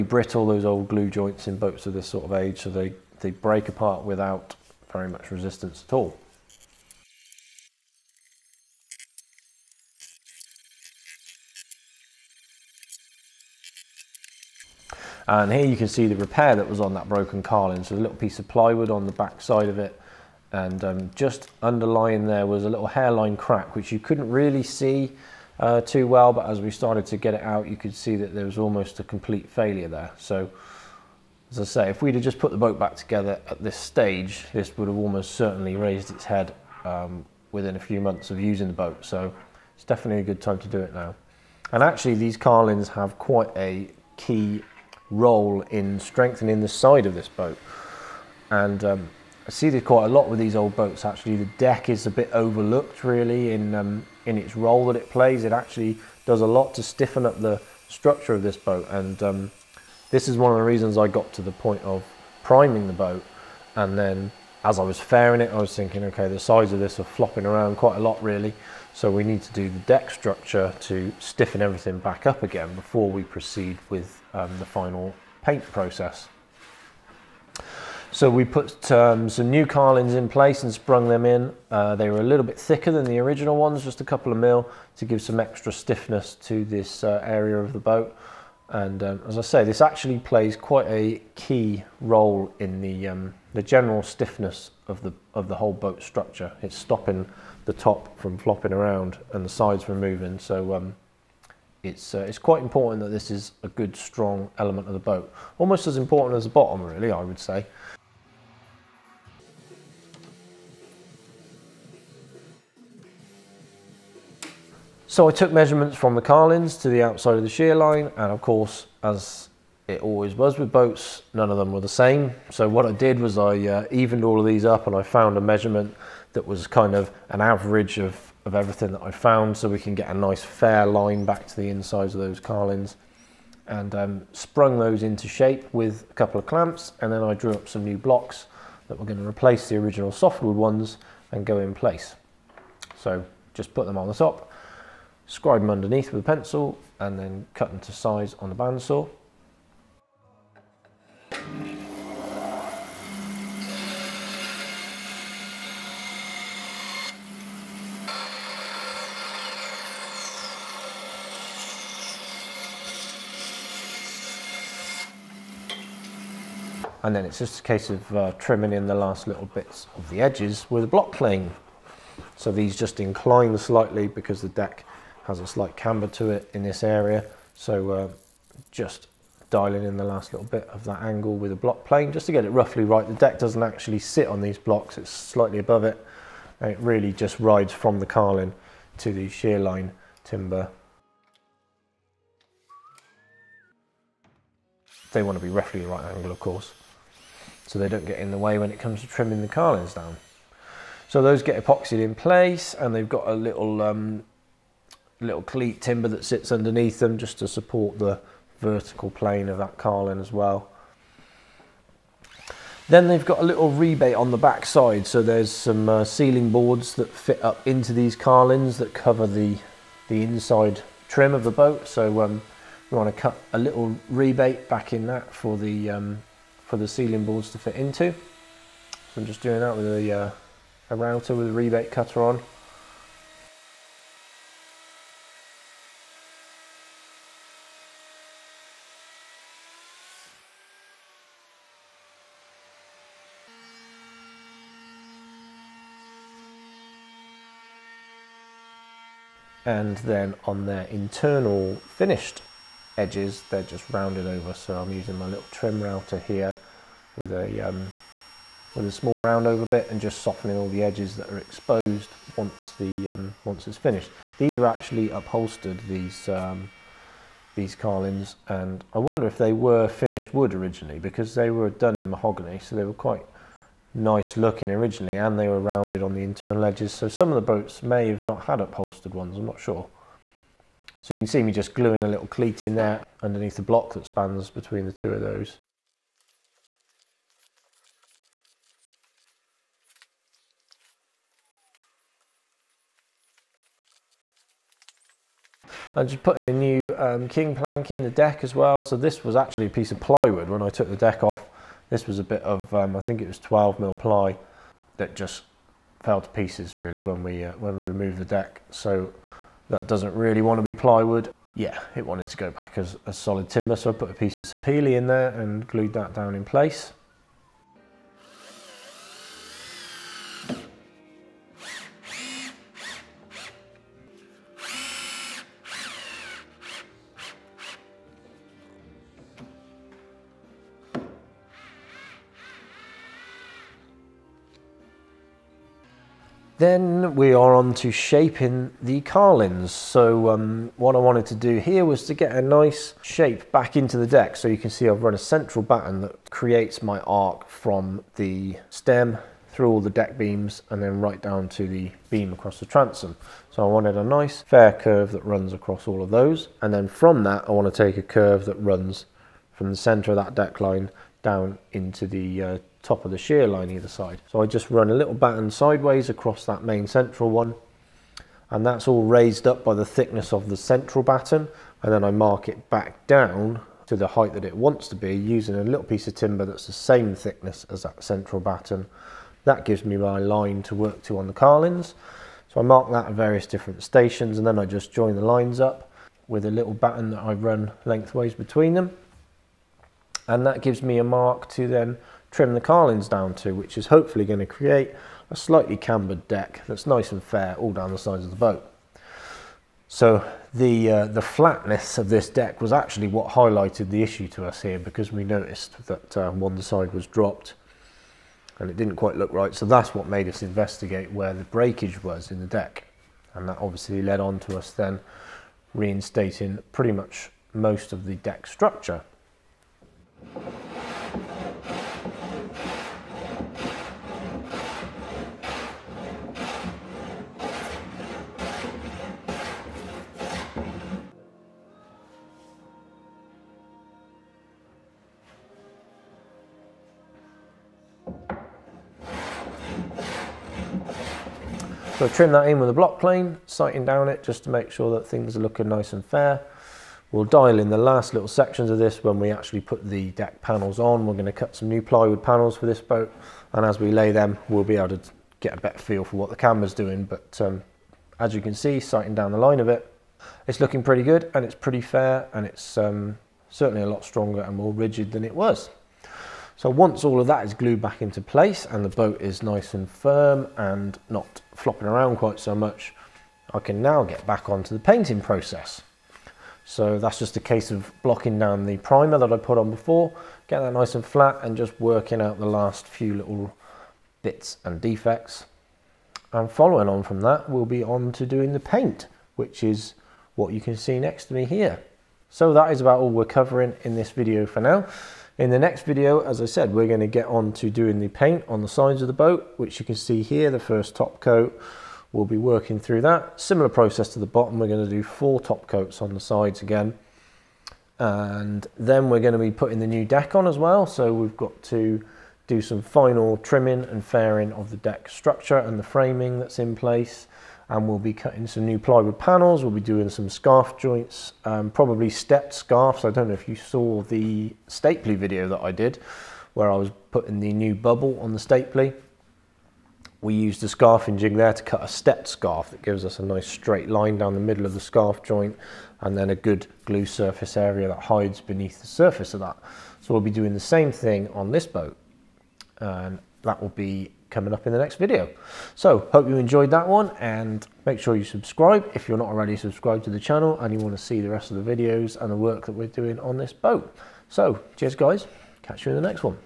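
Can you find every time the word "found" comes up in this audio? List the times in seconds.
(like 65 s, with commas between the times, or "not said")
125 s, 129 s.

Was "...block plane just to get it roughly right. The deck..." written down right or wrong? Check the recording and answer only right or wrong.
right.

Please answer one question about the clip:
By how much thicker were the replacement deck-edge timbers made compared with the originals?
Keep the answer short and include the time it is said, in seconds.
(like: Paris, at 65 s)
a couple of mil, at 83 s.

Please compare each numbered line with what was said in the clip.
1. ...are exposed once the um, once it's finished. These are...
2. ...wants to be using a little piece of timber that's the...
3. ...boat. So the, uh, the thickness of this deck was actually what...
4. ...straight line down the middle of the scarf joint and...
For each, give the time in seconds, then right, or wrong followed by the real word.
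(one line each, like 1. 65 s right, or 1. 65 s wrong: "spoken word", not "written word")
1. 261 s right
2. 374 s right
3. 398 s wrong: "flatness", not "thickness"
4. 533 s right.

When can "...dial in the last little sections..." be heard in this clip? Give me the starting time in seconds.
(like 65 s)
447 s.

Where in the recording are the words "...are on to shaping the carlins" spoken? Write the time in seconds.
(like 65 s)
337 s.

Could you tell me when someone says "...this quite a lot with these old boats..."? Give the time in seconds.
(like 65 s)
49 s.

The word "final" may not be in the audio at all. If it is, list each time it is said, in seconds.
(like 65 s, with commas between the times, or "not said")
74 s, 512 s.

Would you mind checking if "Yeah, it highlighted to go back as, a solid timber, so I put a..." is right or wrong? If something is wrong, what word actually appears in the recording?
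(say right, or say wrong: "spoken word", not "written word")
wrong: "wanted", not "highlighted".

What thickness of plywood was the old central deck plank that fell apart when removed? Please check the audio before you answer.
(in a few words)
12 mil.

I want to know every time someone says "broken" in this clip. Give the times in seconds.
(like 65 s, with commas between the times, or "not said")
17 s.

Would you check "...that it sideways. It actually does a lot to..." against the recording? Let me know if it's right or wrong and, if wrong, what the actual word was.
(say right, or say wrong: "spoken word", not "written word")
wrong: "plays", not "sideways".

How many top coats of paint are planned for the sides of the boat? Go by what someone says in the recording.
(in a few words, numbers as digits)
4.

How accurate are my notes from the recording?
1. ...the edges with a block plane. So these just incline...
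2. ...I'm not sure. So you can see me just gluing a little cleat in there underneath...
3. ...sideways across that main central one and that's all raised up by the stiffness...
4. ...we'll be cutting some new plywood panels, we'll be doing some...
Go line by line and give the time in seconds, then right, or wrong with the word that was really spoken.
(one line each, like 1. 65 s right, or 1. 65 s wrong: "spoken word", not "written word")
1. 170 s right
2. 279 s right
3. 365 s wrong: "thickness", not "stiffness"
4. 517 s right.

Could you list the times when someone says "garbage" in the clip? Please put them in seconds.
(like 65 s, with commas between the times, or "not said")
not said.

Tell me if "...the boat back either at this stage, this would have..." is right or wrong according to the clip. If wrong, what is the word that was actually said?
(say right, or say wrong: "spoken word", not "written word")
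wrong: "together", not "either".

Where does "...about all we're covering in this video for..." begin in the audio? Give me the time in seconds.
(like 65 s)
492 s.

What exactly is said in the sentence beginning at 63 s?
And then as I was fairing it, I was thinking, okay, the sides of this are flopping around quite a lot really.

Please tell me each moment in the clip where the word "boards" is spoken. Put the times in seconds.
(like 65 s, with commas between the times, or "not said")
216 s, 227 s.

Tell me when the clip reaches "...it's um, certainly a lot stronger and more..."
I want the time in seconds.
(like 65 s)
462 s.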